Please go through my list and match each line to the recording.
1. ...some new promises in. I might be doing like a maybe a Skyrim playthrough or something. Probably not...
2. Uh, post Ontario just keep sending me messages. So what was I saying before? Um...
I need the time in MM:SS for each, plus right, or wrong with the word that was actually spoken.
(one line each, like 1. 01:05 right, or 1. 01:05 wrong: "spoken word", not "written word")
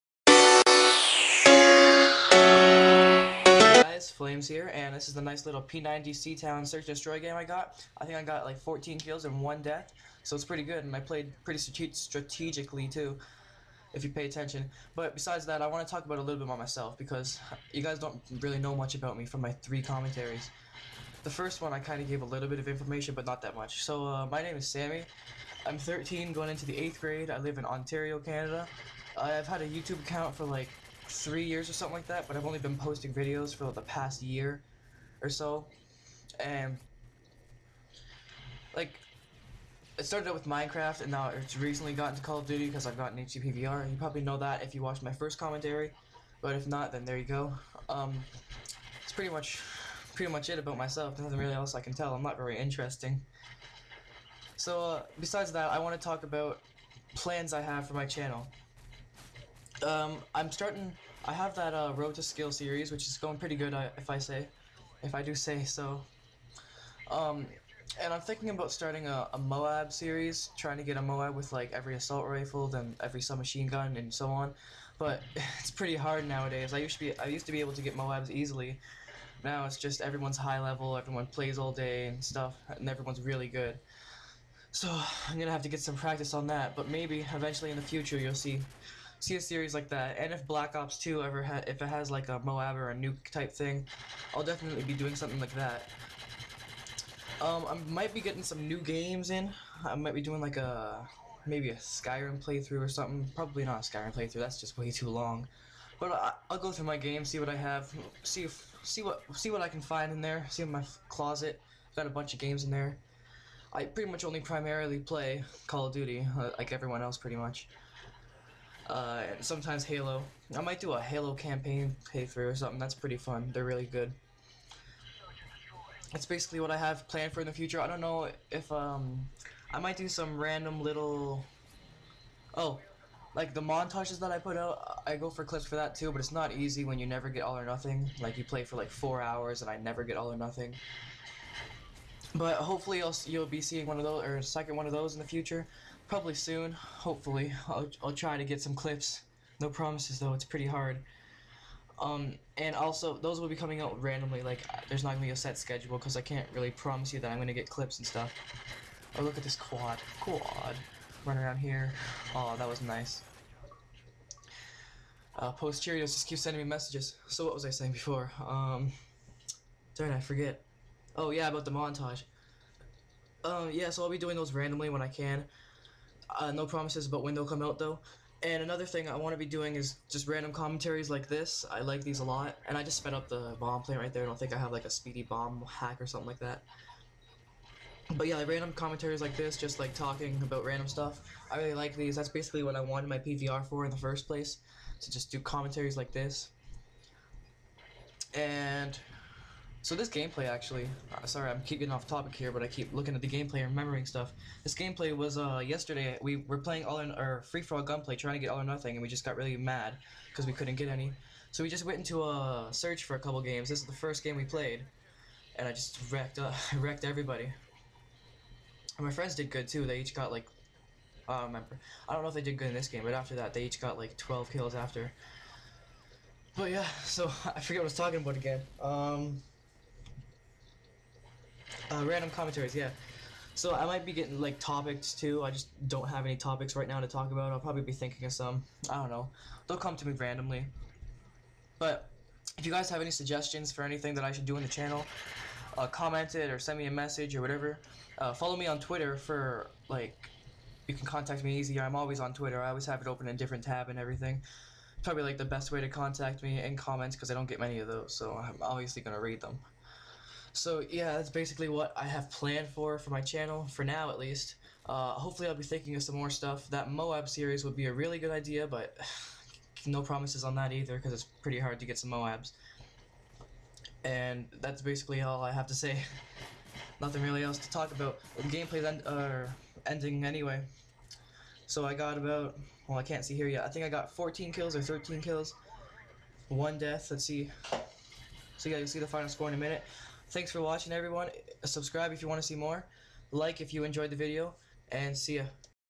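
1. 01:38 wrong: "games", not "promises"
2. 02:45 wrong: "Cheerios", not "Ontario".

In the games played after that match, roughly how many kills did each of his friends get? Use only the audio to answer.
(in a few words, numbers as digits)
12.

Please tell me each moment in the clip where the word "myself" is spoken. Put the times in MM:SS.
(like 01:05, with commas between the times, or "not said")
00:16, 00:50.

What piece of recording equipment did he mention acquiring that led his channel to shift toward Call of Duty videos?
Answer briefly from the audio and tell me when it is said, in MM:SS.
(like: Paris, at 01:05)
HD PVR, at 00:43.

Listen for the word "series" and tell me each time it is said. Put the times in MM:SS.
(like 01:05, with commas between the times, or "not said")
01:02, 01:09, 01:29, 04:27.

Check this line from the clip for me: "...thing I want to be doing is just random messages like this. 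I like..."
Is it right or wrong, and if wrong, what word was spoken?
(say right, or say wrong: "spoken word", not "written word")
wrong: "commentaries", not "messages".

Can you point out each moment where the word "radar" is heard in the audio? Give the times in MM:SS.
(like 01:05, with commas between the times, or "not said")
not said.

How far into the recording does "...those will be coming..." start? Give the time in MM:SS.
02:33.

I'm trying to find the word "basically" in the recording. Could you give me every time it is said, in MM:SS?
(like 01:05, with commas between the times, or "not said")
02:06, 03:12, 04:21, 04:34.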